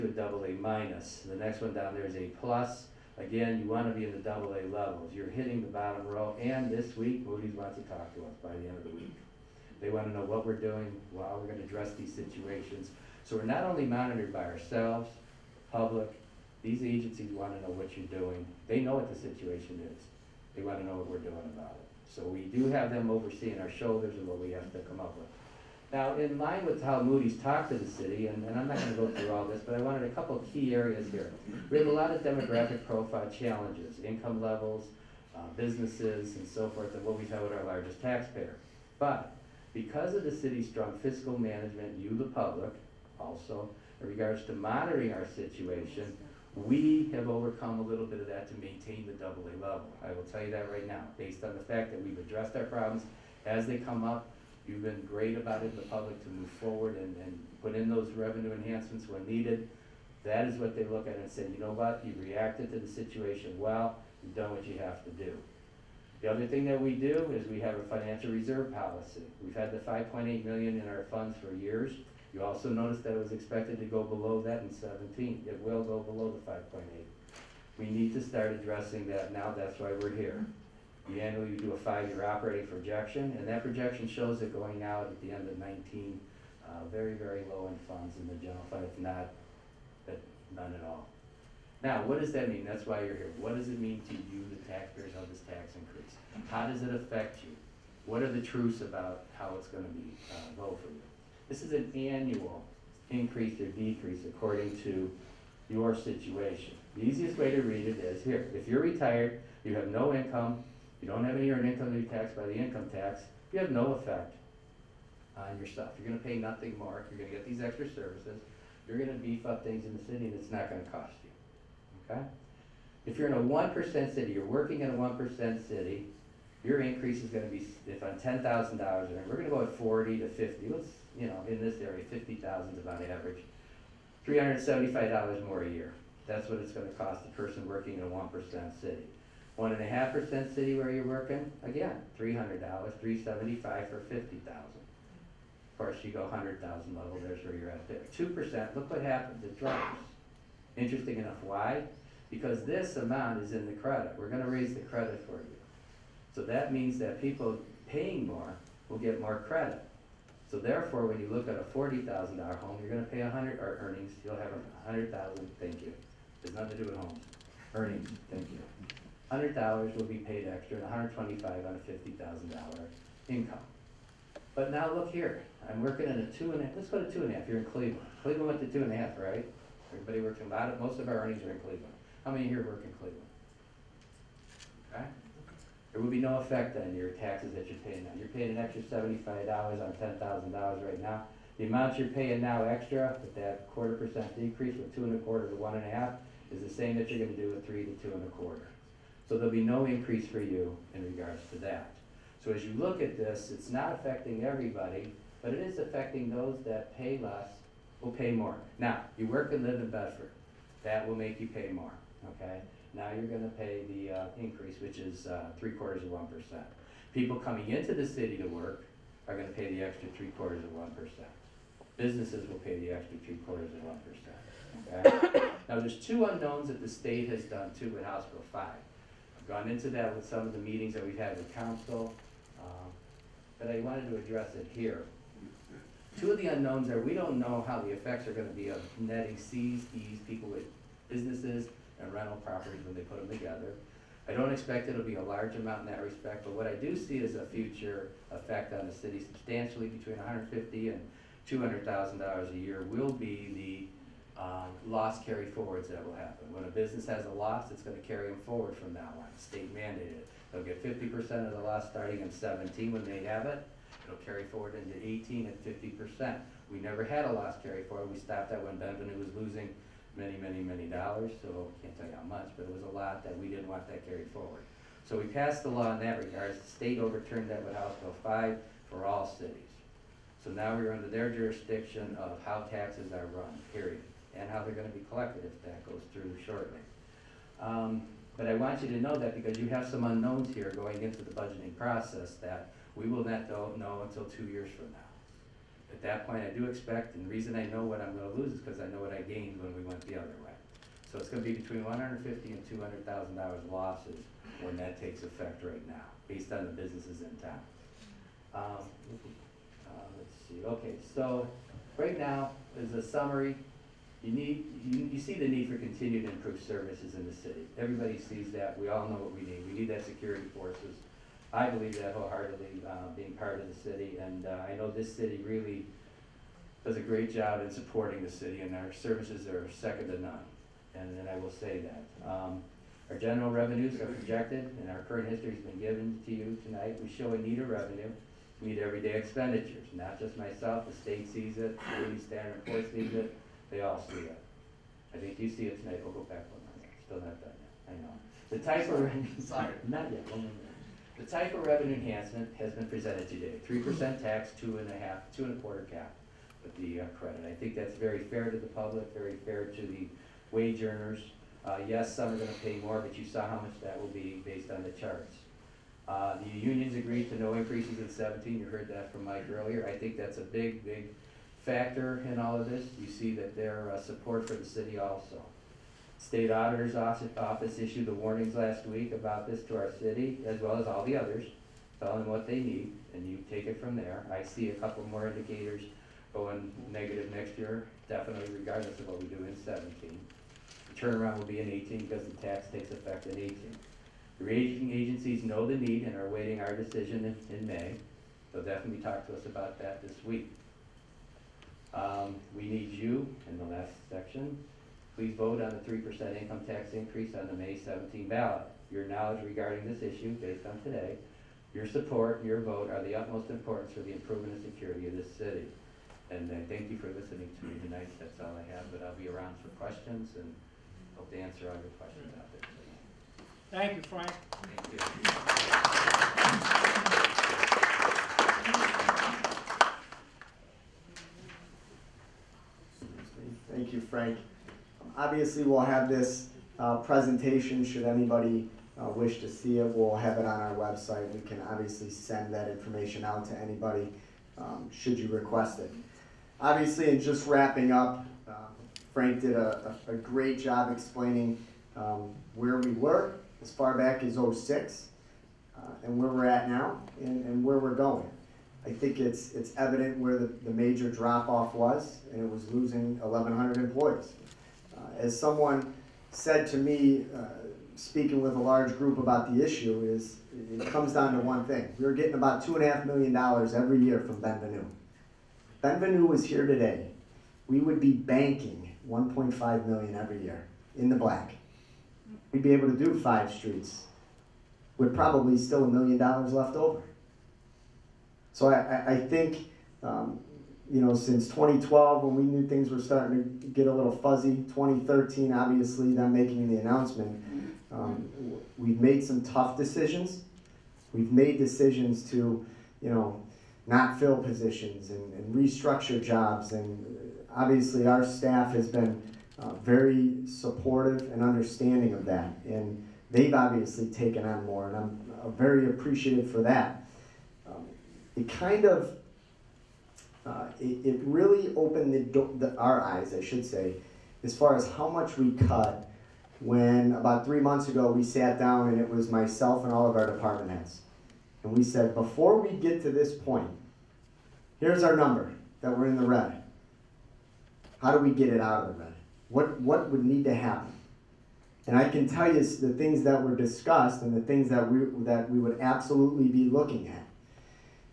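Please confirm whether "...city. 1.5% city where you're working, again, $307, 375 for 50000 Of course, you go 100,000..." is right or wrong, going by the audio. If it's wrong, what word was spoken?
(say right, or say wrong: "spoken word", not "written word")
wrong: "300", not "307".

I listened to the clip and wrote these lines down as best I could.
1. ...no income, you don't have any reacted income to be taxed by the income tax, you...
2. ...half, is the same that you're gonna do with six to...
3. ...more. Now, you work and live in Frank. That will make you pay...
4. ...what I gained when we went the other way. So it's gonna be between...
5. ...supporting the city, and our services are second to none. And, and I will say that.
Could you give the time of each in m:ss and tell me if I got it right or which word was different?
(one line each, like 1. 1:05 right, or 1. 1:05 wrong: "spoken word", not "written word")
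1. 1:49 wrong: "earned", not "reacted"
2. 3:15 wrong: "three", not "six"
3. 3:28 wrong: "Bedford", not "Frank"
4. 4:58 right
5. 5:27 right.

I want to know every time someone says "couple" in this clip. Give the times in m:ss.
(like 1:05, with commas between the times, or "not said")
0:30, 6:24.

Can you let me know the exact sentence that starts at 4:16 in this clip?
When a business has a loss, it's going to carry them forward from that one.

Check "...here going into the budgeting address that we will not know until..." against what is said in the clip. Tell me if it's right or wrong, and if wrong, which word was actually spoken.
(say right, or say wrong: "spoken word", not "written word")
wrong: "process", not "address".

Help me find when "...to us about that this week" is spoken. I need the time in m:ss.
6:39.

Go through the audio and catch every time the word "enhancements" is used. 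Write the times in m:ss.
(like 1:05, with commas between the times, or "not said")
0:58, 5:51.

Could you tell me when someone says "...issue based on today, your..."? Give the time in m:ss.
6:50.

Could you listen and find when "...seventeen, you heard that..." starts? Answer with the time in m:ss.
6:08.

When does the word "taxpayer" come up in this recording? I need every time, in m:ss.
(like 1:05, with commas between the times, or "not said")
0:38, 1:34.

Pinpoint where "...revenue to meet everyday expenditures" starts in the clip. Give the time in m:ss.
5:37.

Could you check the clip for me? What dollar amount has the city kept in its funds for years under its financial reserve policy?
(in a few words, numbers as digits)
$5.8 million.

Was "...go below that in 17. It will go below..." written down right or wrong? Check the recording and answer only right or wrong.
right.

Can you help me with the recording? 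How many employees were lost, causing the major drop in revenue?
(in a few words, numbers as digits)
1,100.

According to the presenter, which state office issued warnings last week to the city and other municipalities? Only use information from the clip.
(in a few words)
State Auditor's Office.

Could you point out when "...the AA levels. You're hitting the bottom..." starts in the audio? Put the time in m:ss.
0:04.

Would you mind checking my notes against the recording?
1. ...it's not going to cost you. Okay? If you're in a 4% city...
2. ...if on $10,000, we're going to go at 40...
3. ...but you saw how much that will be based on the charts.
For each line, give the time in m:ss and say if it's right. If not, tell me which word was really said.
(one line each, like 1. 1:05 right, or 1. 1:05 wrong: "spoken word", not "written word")
1. 2:00 wrong: "1", not "4"
2. 2:07 right
3. 6:02 right.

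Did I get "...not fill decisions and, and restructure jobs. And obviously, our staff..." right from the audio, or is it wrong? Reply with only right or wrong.
wrong.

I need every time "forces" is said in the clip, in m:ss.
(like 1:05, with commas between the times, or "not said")
5:20, 5:42.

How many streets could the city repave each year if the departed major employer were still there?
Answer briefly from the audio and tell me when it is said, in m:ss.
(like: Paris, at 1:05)
5, at 8:03.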